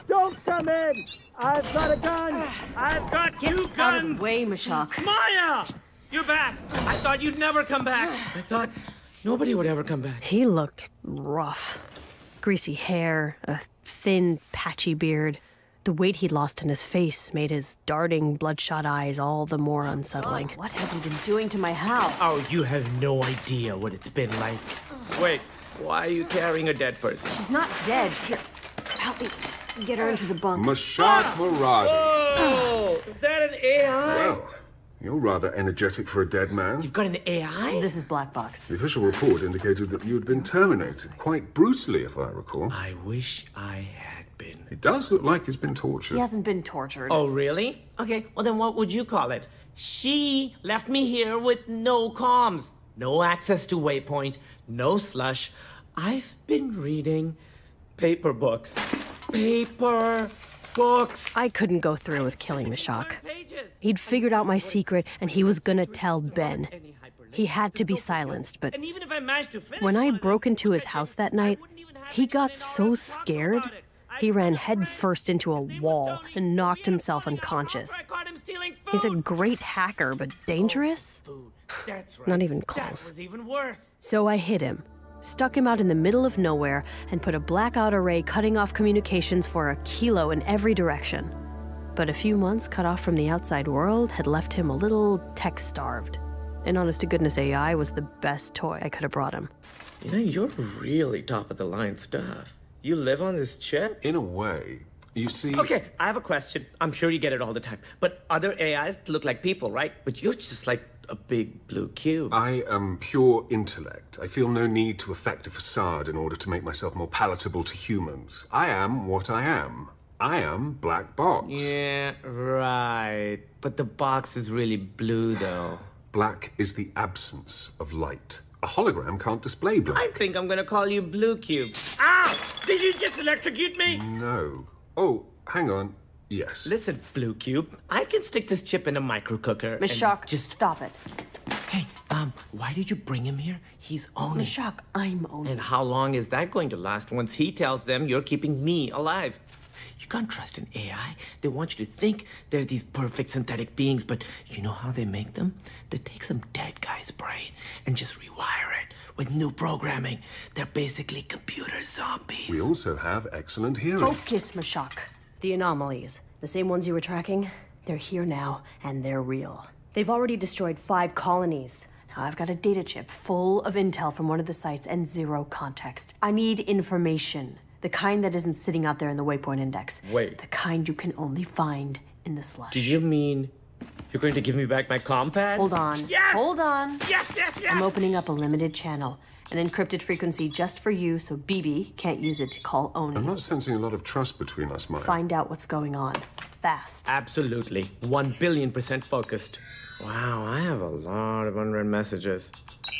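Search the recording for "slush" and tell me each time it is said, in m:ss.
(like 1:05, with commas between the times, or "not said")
0:54, 3:02.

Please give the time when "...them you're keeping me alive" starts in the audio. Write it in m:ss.
2:27.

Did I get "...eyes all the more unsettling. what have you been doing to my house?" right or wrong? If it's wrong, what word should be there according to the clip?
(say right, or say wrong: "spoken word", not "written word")
right.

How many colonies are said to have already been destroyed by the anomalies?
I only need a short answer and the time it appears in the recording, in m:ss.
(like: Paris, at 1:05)
5, at 2:50.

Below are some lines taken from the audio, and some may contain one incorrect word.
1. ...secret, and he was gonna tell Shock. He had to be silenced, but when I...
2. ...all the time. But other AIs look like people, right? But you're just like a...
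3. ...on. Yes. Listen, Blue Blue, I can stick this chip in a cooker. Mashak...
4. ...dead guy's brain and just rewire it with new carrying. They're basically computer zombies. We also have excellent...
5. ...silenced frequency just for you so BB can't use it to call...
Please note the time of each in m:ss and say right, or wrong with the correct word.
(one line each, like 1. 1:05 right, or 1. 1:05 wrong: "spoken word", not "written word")
1. 1:04 wrong: "Ben", not "Shock"
2. 1:47 right
3. 2:15 wrong: "Cube", not "Blue"
4. 2:36 wrong: "programming", not "carrying"
5. 3:09 wrong: "encrypted", not "silenced".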